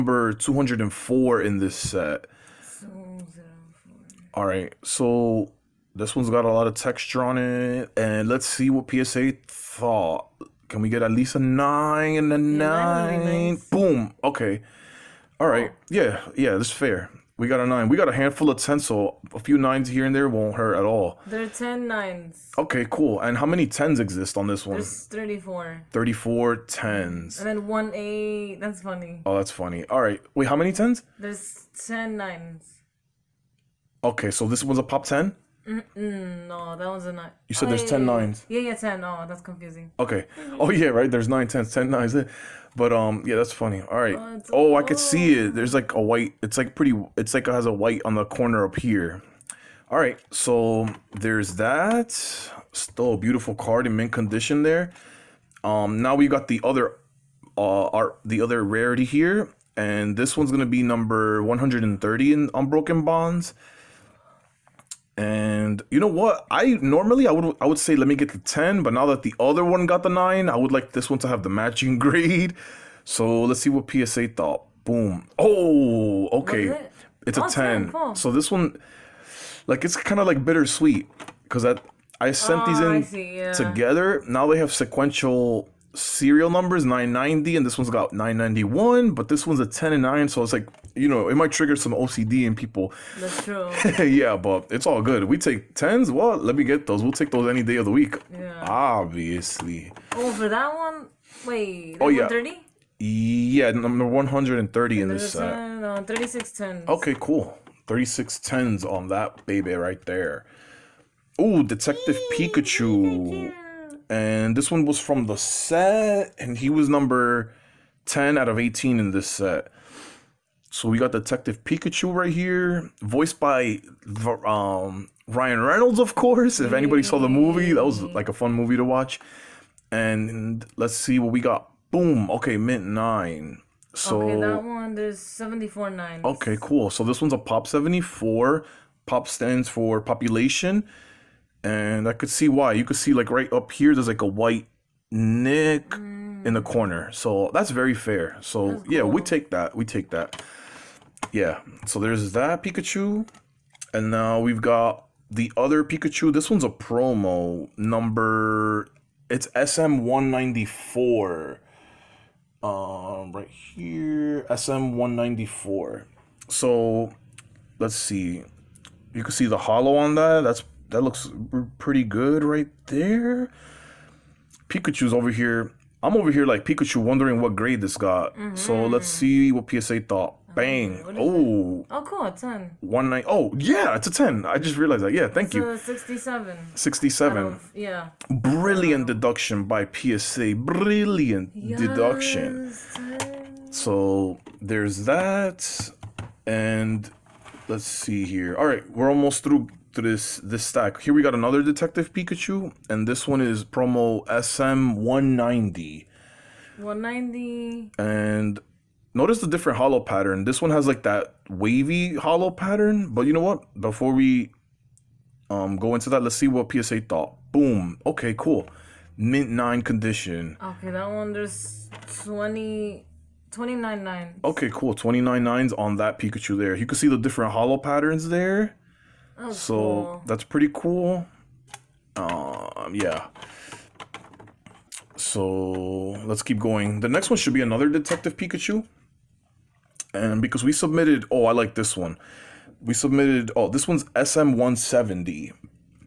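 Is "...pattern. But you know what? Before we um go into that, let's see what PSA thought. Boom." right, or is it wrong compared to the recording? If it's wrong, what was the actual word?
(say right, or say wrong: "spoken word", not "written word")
right.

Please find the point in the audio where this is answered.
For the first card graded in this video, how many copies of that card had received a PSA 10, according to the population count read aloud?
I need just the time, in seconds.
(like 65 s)
24 s.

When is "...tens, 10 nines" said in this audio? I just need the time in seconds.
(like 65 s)
41 s.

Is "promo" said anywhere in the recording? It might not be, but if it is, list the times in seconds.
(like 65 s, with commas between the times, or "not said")
156 s, 203 s.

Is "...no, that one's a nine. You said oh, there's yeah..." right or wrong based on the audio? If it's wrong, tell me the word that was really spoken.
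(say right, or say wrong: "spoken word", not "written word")
right.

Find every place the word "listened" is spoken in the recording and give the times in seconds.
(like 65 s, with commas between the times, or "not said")
not said.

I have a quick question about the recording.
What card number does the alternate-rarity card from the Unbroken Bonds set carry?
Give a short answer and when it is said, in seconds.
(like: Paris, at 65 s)
130, at 60 s.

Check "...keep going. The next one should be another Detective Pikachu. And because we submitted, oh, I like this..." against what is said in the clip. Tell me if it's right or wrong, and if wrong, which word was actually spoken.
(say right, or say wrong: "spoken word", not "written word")
right.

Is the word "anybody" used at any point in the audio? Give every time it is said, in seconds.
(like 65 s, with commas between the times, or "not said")
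126 s.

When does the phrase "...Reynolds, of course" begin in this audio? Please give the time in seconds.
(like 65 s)
125 s.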